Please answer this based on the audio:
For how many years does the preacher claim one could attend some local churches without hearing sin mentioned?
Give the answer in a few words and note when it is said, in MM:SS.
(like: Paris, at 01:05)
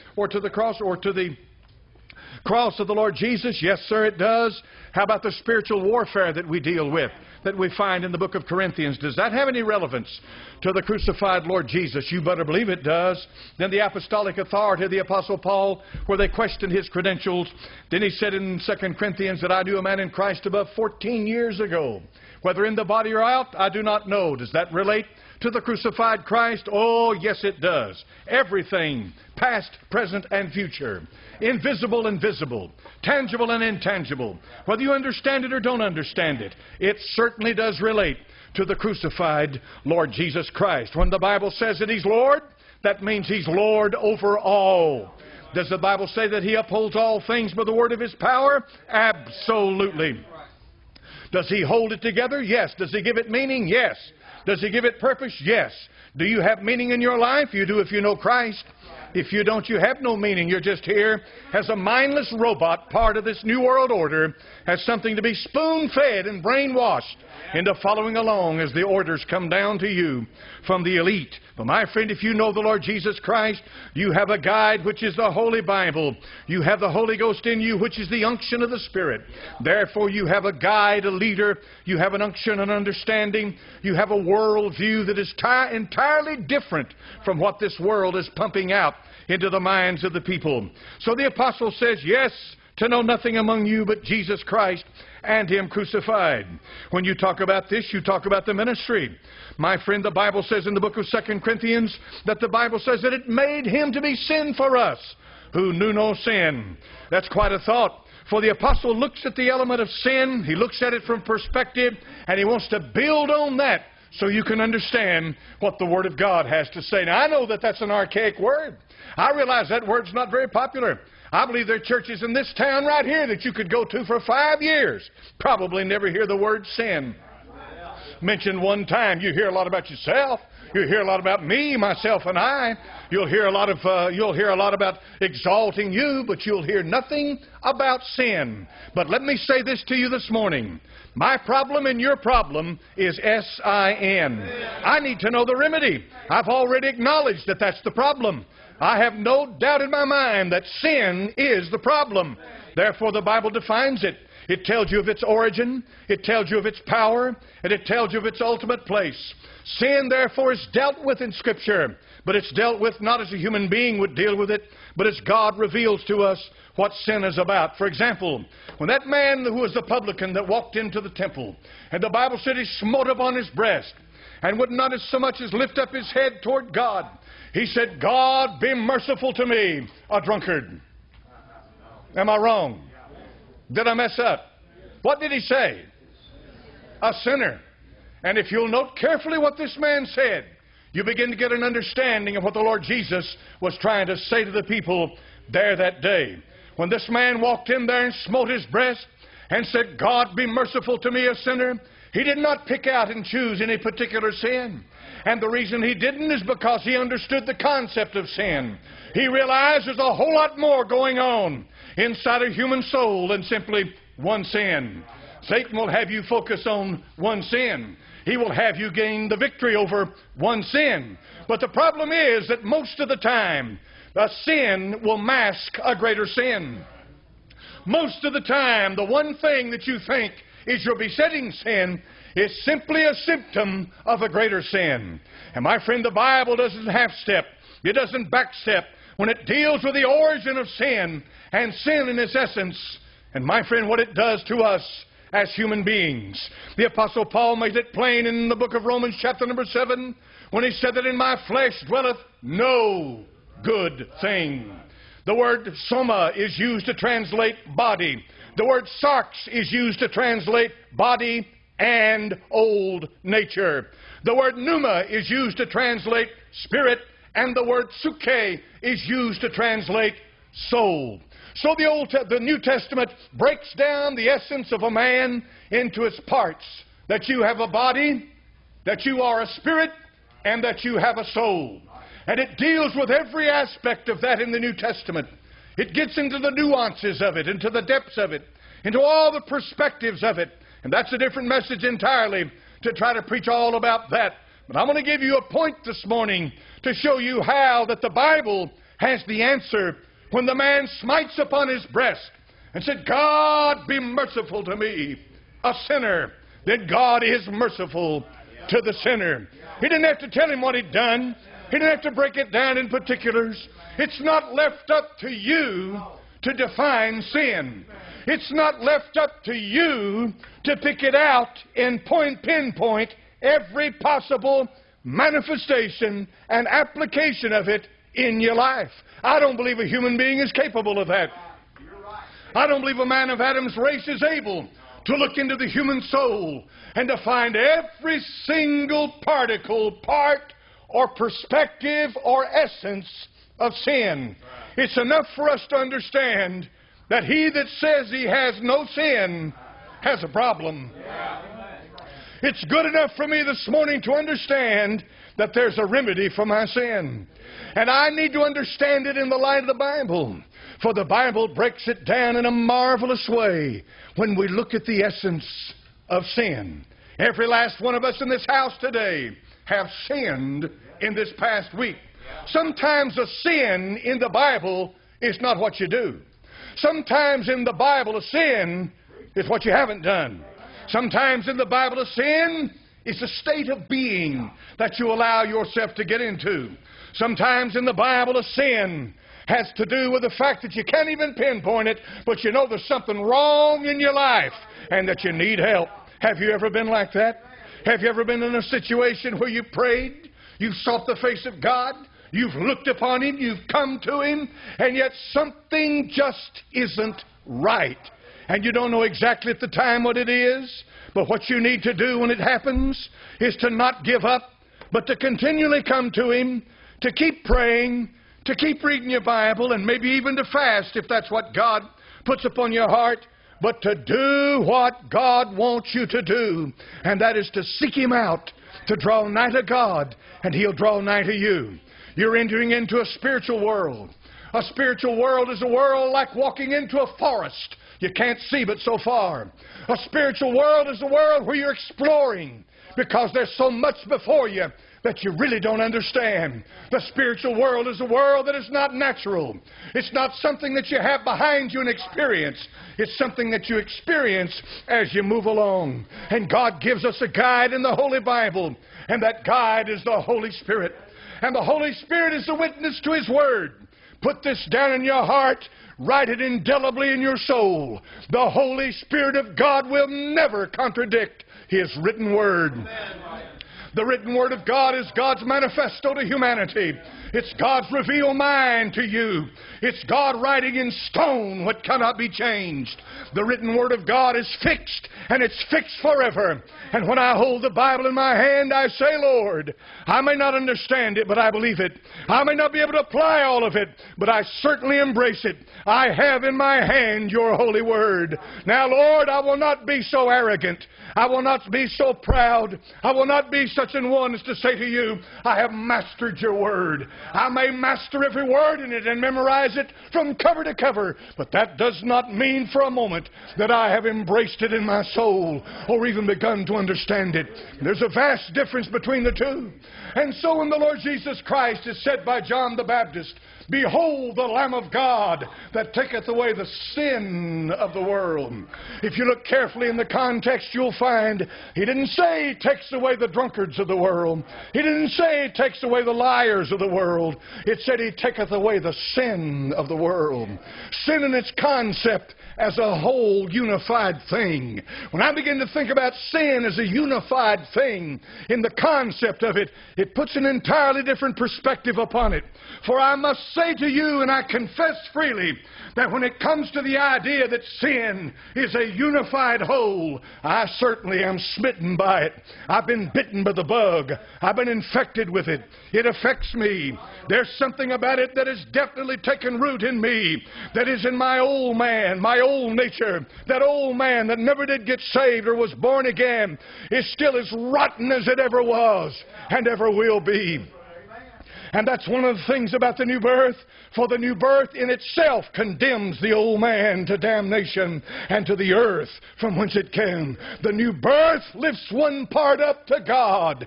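five years, at 02:04.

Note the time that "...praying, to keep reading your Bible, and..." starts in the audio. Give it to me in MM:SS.
06:57.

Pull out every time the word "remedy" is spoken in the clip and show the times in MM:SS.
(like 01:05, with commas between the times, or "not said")
02:25, 05:55.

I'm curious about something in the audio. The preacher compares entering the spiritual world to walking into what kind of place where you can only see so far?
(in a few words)
a forest.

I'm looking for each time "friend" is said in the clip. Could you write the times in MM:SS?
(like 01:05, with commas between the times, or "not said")
01:11, 01:39, 03:55, 04:03.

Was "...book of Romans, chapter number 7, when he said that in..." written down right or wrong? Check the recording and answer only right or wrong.
right.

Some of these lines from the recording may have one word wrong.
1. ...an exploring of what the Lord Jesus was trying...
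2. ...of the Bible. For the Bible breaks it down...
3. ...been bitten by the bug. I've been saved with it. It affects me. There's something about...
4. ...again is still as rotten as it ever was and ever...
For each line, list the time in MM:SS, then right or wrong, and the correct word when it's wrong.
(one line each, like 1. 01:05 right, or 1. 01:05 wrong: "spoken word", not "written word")
1. 03:11 wrong: "understanding", not "exploring"
2. 05:59 right
3. 09:22 wrong: "infected", not "saved"
4. 09:36 right.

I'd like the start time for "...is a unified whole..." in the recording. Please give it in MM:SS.
09:18.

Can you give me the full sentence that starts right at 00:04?
How about the spiritual warfare that we deal with, that we find in the book of Corinthians?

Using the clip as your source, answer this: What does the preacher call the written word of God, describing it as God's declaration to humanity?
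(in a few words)
manifesto.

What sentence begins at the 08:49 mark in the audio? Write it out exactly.
If you look carefully in the context, you'll find he didn't say He takes away the drunkards of the world.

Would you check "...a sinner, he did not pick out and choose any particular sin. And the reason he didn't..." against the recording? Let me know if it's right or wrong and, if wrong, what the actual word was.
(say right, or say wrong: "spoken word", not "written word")
right.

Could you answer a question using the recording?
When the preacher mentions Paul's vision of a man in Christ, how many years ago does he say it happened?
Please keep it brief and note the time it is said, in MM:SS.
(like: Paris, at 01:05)
14, at 00:20.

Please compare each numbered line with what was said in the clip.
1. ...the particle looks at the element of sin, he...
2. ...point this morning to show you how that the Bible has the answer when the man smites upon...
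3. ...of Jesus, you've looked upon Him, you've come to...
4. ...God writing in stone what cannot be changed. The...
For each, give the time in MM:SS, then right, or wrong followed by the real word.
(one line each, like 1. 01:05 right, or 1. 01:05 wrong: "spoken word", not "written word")
1. 01:48 wrong: "apostle", not "particle"
2. 04:55 right
3. 06:41 wrong: "God", not "Jesus"
4. 08:00 right.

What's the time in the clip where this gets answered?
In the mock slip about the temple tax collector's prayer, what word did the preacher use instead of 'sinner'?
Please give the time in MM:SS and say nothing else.
03:00.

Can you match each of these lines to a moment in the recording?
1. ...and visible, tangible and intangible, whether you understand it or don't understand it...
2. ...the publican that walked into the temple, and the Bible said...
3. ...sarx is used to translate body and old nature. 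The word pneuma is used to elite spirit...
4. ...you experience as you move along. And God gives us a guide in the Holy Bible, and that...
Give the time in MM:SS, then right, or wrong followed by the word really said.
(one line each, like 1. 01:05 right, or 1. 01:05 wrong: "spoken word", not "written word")
1. 00:32 right
2. 02:49 right
3. 04:19 wrong: "translate", not "elite"
4. 07:33 right.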